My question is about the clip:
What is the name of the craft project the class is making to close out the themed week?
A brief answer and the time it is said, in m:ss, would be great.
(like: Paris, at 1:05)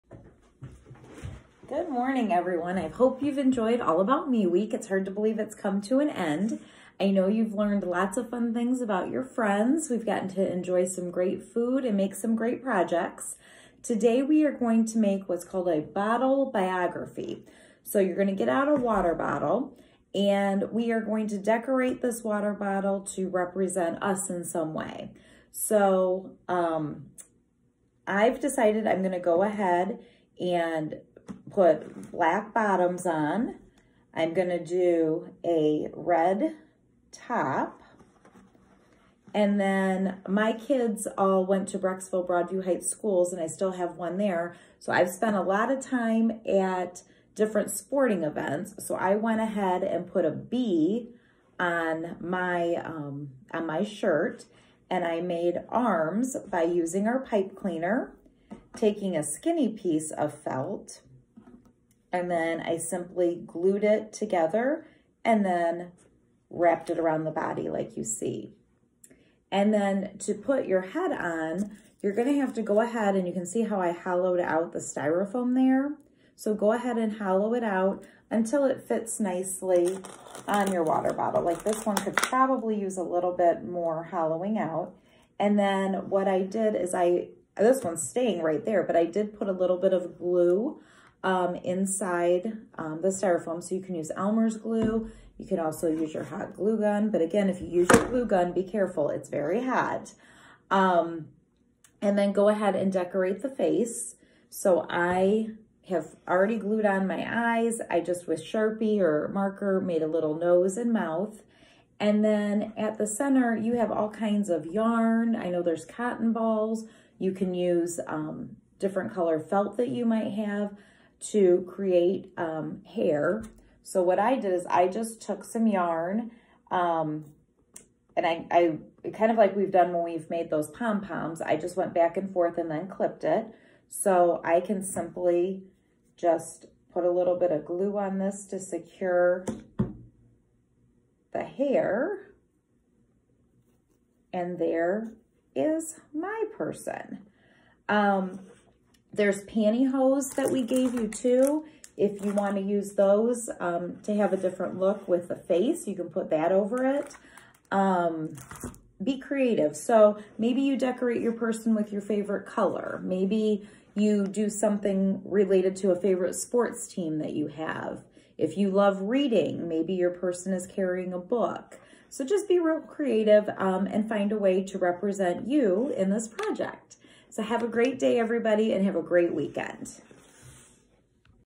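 bottle biography, at 0:15.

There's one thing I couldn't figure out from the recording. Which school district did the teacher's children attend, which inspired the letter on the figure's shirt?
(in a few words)
Brecksville Broadview Heights.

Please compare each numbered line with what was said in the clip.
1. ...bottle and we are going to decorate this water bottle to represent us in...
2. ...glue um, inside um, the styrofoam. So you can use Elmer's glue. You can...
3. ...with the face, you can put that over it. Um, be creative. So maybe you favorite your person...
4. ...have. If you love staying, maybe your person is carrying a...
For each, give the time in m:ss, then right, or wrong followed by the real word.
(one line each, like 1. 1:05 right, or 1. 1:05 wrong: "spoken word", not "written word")
1. 0:19 right
2. 1:30 right
3. 2:35 wrong: "decorate", not "favorite"
4. 2:47 wrong: "reading", not "staying".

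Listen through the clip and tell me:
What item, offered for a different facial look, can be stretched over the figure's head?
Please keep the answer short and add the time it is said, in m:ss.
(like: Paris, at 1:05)
pantyhose, at 2:29.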